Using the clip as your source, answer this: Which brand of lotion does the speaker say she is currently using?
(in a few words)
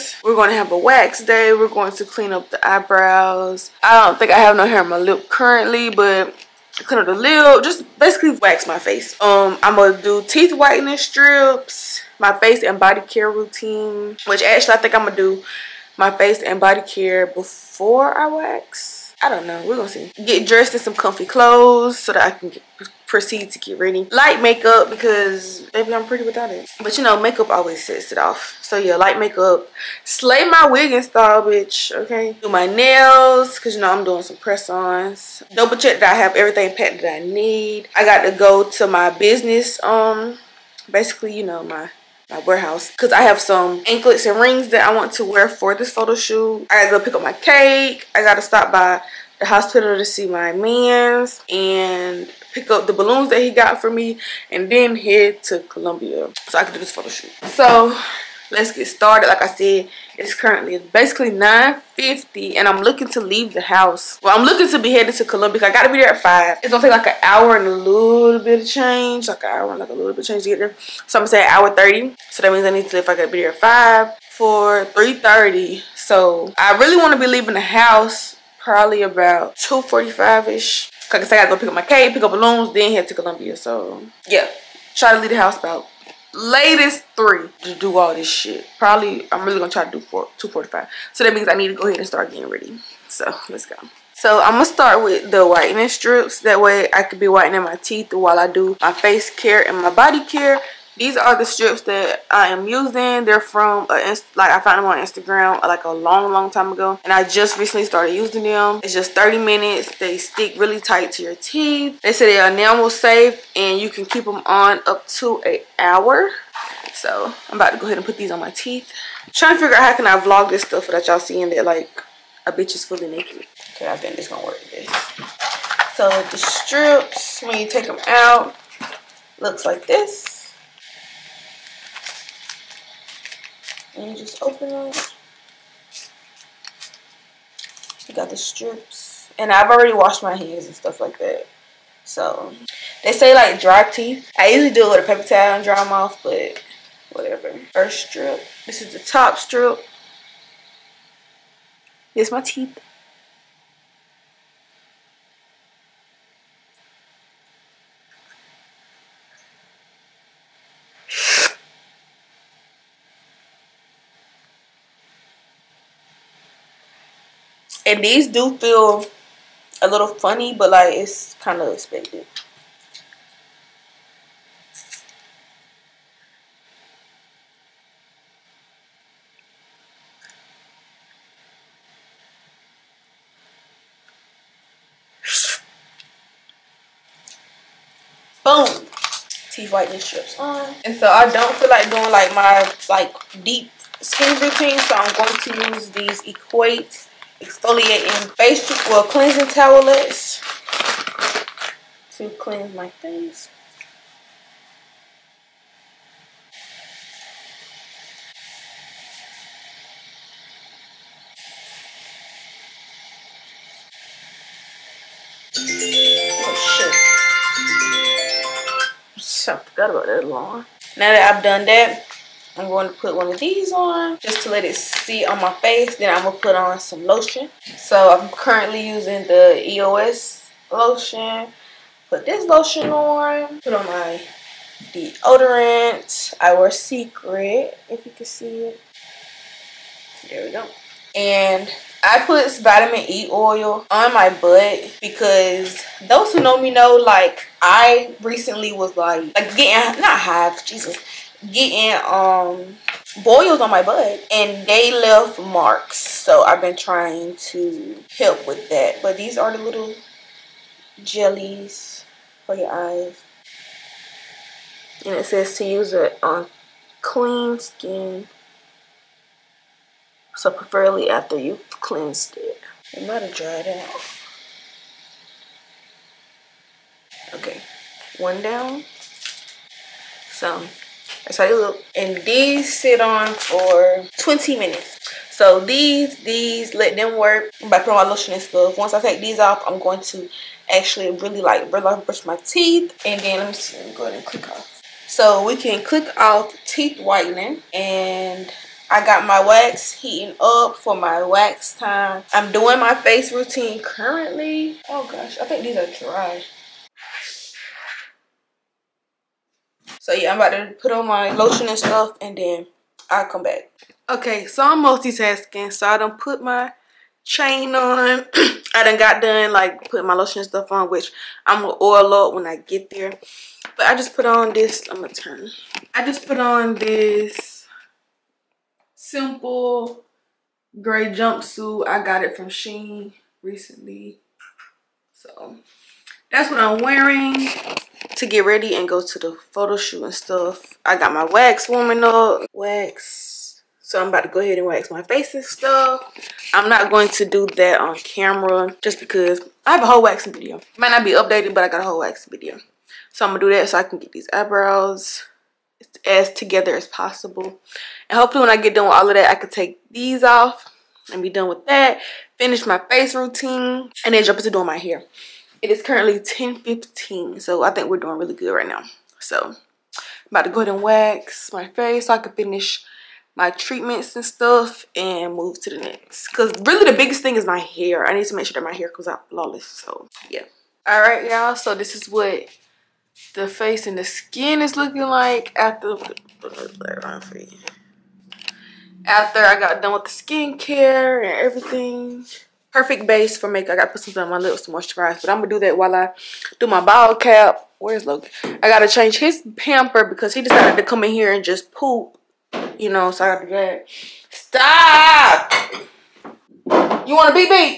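EOS.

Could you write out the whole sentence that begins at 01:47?
And I just recently started using them.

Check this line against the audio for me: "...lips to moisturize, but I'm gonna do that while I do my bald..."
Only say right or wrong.
right.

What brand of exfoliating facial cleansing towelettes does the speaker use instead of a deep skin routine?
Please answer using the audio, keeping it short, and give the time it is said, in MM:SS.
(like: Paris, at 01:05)
Equate, at 03:16.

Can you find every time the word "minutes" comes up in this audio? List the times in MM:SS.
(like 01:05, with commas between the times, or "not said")
01:49, 04:44.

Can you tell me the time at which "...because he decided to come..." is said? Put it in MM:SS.
06:40.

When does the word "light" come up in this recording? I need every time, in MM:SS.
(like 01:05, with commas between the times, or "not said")
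00:24, 00:28.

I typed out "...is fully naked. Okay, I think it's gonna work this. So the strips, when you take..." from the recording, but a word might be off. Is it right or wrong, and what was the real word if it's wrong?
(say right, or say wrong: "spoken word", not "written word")
right.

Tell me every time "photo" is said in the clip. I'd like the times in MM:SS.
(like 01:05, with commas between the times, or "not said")
00:45, 00:56, 05:39.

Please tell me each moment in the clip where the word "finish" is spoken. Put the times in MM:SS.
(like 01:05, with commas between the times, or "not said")
06:02, 06:12.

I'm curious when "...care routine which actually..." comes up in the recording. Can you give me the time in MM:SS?
00:13.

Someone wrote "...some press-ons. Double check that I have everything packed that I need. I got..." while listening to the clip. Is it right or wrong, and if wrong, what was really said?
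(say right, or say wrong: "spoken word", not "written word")
right.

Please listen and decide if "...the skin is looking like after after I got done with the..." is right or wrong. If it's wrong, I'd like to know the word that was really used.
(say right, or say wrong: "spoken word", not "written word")
right.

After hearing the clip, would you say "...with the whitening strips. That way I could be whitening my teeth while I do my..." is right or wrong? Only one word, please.
right.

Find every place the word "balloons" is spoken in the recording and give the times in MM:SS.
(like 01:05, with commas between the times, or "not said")
00:52, 01:22.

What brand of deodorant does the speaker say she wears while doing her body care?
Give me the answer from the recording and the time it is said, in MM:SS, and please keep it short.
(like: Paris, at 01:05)
Secret, at 03:56.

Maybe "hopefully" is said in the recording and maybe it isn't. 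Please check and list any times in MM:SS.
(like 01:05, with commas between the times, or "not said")
05:58.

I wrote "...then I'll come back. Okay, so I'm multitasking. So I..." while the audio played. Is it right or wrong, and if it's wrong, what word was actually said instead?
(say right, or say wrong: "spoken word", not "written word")
right.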